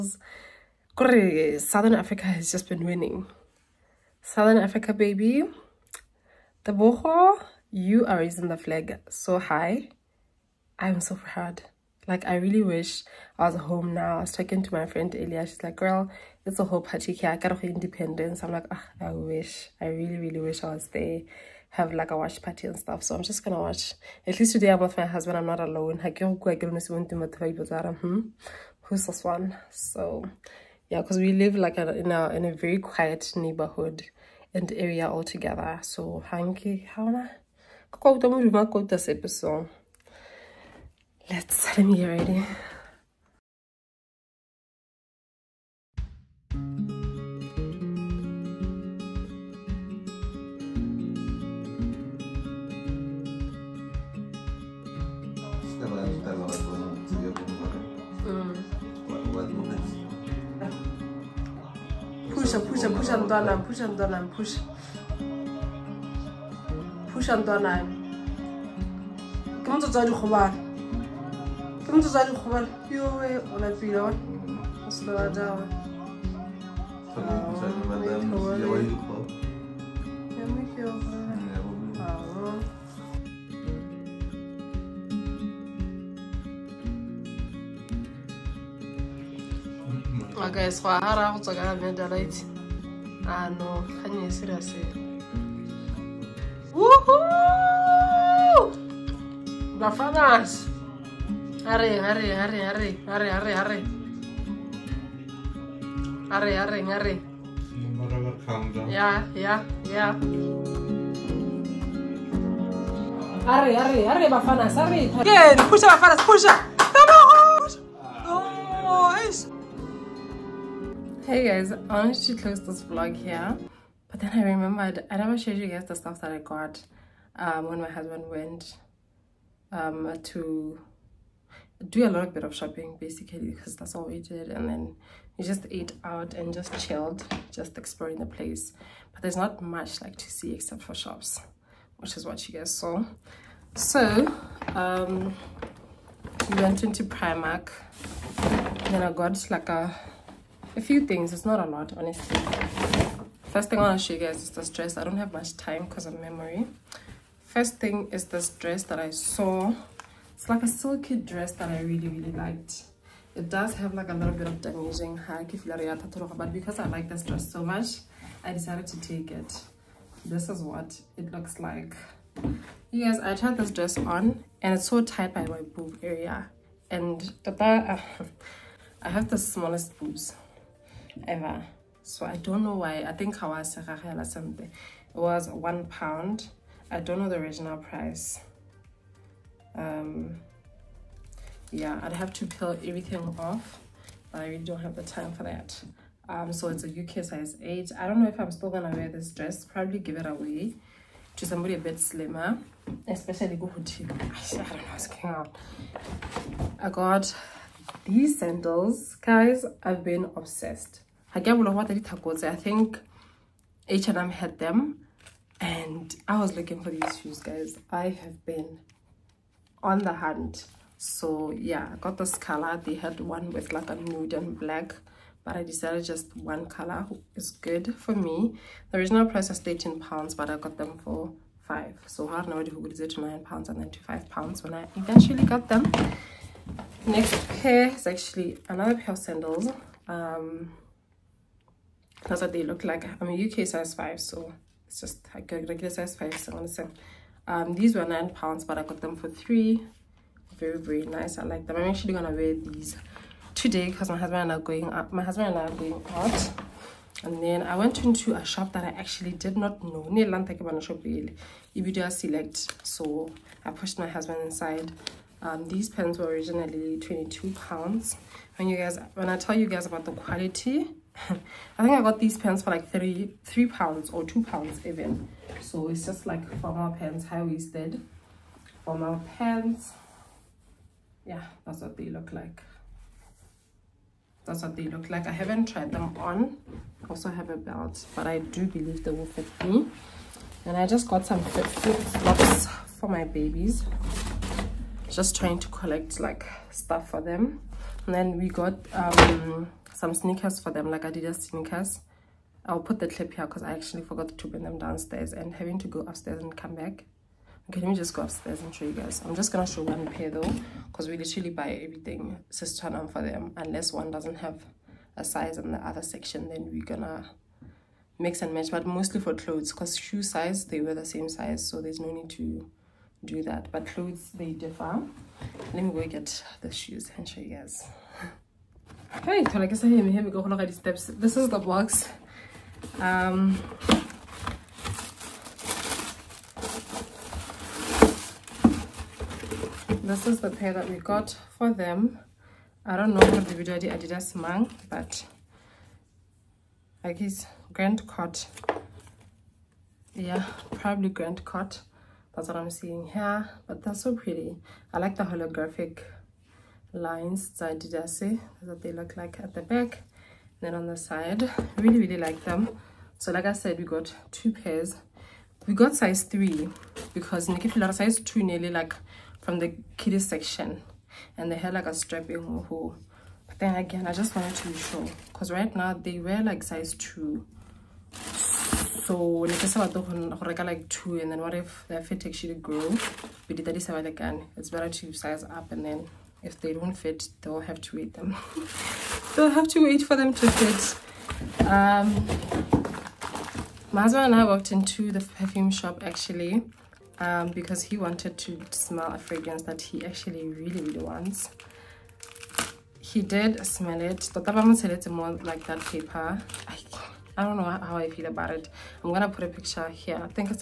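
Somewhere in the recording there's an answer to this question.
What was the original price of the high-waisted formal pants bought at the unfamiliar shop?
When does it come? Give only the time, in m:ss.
4:26.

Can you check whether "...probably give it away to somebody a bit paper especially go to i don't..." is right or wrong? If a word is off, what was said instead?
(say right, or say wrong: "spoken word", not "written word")
wrong: "slimmer", not "paper".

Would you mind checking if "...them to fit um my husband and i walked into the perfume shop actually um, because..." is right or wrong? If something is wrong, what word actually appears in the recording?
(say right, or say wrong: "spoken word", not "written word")
right.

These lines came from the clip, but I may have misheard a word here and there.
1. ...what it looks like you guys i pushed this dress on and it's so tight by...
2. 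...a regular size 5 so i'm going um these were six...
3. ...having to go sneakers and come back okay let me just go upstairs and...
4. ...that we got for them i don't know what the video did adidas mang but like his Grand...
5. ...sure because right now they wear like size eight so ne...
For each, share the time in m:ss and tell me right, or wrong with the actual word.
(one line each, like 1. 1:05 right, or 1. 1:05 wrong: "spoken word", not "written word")
1. 2:50 wrong: "tried", not "pushed"
2. 4:05 wrong: "nine", not "six"
3. 5:05 wrong: "upstairs", not "sneakers"
4. 5:40 right
5. 6:14 wrong: "two", not "eight".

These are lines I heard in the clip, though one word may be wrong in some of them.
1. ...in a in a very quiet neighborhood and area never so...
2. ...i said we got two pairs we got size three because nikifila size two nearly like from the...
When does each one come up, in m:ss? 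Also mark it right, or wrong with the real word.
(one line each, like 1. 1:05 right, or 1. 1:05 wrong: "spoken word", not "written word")
1. 0:31 wrong: "altogether", not "never"
2. 6:03 right.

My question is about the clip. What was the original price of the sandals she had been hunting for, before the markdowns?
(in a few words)
13 pounds.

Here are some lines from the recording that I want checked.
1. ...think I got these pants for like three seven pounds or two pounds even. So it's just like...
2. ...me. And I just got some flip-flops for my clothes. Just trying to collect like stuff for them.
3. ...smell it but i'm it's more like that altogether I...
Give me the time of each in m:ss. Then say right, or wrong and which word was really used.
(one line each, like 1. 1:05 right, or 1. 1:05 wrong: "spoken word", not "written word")
1. 4:31 wrong: "three", not "seven"
2. 4:49 wrong: "babies", not "clothes"
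3. 6:43 wrong: "paper", not "altogether".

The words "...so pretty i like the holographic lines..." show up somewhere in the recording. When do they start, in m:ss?
5:54.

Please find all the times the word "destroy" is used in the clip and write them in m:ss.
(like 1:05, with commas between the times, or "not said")
not said.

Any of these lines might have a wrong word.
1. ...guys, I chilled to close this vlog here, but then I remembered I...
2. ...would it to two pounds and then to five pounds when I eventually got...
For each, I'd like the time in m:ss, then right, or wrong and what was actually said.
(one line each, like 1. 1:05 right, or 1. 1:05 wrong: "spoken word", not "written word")
1. 2:01 wrong: "wanted", not "chilled"
2. 3:52 wrong: "nine", not "two".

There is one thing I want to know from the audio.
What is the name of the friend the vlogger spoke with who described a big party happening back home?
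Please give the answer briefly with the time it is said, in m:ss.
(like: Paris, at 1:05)
Elia, at 0:15.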